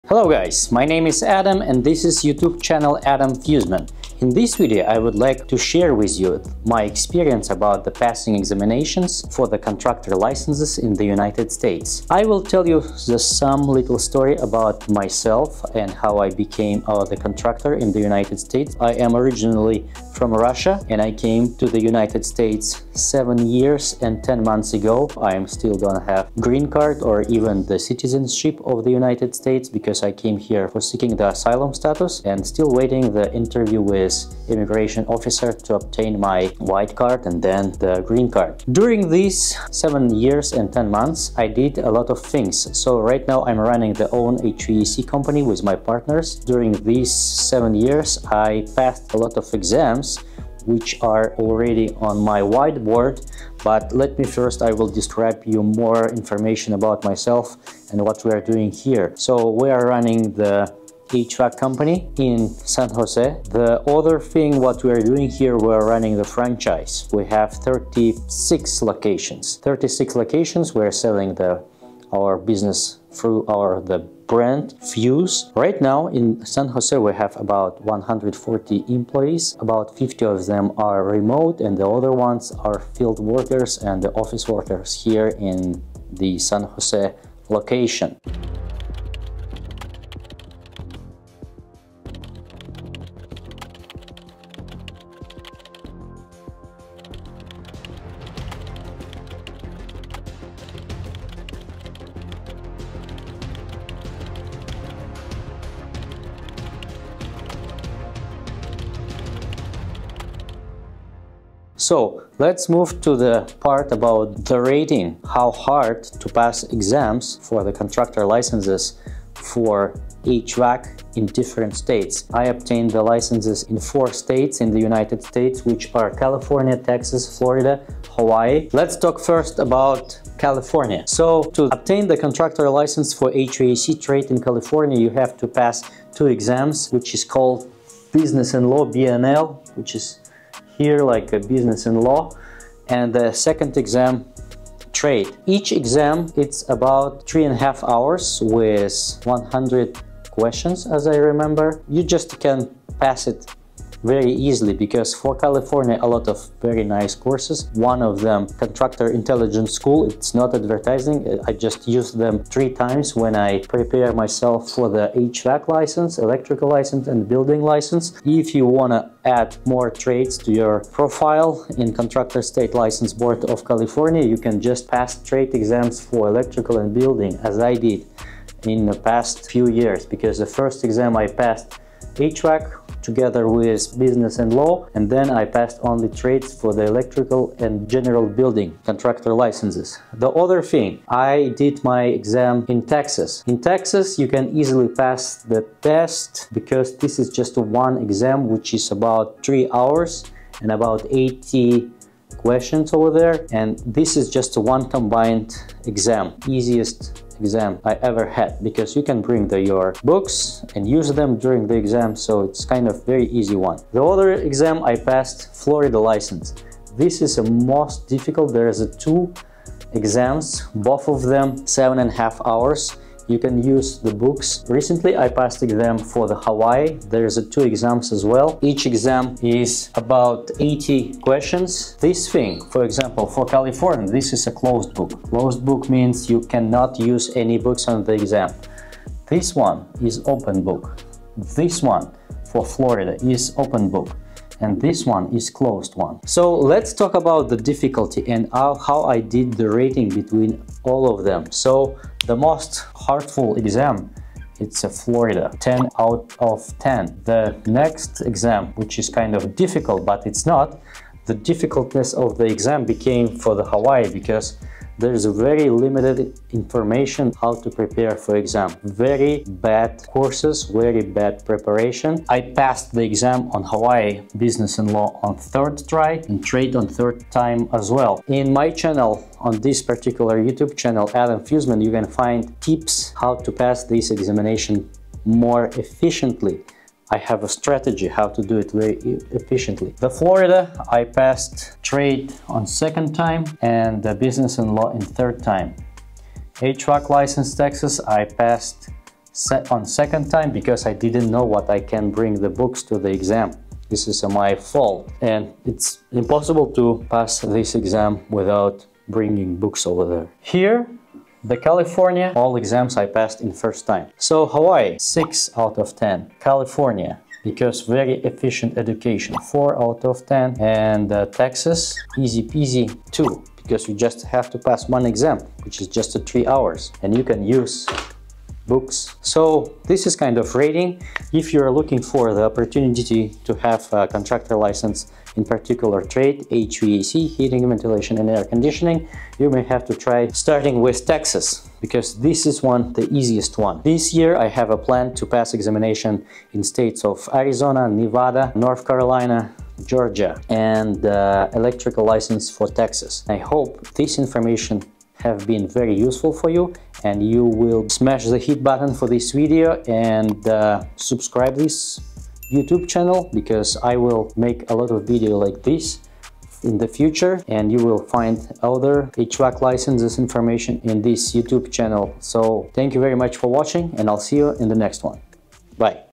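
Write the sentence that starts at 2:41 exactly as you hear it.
Uh, I just use them three times when I prepare myself for the HVAC license, electrical license, and building license.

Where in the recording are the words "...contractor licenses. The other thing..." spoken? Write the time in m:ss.
3:08.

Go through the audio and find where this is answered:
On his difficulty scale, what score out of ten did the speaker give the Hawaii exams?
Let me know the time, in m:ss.
5:14.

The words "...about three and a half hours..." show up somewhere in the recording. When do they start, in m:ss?
2:26.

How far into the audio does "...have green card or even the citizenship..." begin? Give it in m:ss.
0:26.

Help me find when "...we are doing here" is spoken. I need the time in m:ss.
0:58.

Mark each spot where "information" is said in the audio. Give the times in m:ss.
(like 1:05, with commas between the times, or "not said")
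0:56, 4:26, 5:54, 6:10.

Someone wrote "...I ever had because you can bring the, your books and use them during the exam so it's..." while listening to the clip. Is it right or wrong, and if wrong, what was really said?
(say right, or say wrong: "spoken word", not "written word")
right.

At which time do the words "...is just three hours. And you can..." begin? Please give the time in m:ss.
5:25.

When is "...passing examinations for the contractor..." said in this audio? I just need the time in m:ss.
0:07.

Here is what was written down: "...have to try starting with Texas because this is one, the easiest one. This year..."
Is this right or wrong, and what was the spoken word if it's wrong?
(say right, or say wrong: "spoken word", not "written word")
right.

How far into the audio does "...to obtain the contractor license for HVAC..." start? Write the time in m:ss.
2:11.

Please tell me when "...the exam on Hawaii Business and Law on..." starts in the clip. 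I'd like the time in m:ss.
4:32.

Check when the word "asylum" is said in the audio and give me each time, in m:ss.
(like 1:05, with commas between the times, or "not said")
0:31.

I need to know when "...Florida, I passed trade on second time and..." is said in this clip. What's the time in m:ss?
4:50.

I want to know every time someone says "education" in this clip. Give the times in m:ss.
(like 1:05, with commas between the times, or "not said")
5:18.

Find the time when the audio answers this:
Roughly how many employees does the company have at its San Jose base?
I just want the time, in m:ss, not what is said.
1:17.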